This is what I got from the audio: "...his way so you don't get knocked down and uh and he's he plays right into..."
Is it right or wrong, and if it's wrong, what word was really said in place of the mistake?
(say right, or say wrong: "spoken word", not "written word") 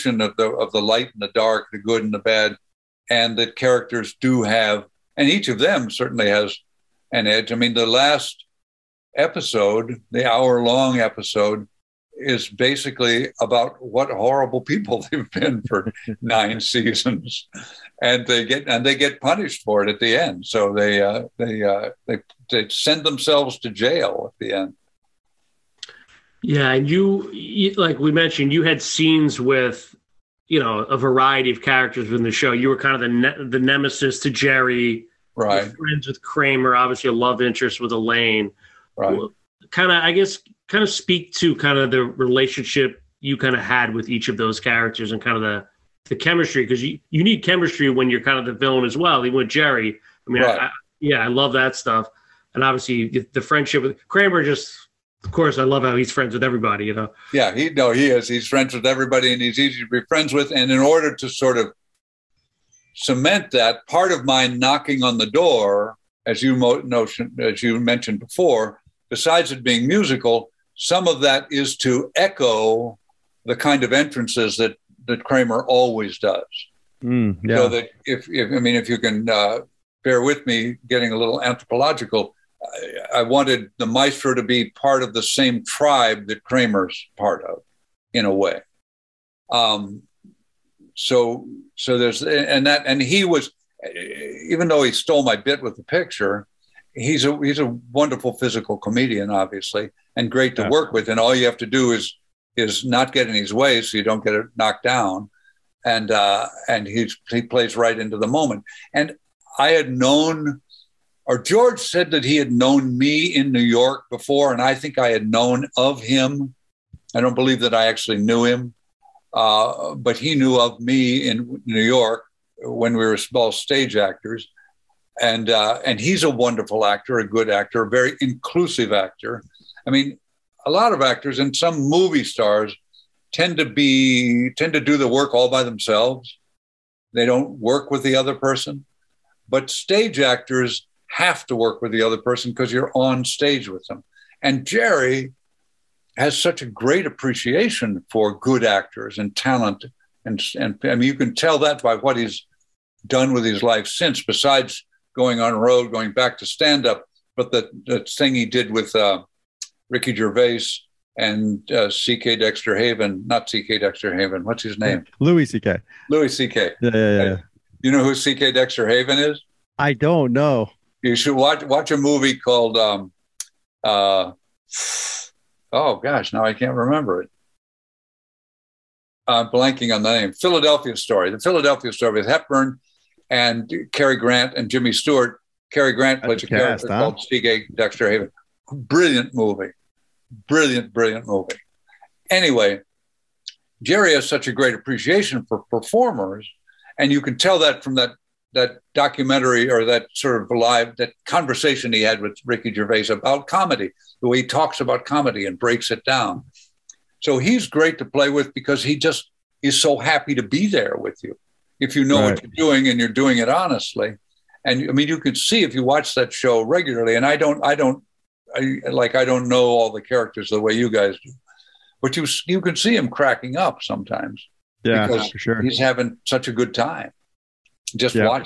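right.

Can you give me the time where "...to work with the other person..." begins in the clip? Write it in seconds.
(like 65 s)
141 s.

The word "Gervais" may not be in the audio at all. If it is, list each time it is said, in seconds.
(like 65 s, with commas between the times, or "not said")
160 s, 202 s.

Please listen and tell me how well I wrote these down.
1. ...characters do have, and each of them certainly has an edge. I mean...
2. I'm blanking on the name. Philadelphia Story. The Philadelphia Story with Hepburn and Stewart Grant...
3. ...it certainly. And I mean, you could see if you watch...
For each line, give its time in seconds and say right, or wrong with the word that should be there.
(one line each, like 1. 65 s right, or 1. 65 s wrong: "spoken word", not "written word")
1. 3 s right
2. 179 s wrong: "Cary", not "Stewart"
3. 213 s wrong: "honestly", not "certainly".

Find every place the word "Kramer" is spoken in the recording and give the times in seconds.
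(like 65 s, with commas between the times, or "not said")
36 s, 54 s, 75 s, 86 s.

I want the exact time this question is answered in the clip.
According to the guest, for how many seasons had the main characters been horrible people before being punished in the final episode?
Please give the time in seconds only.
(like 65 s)
16 s.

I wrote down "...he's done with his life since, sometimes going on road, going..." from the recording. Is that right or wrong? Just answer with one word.
wrong.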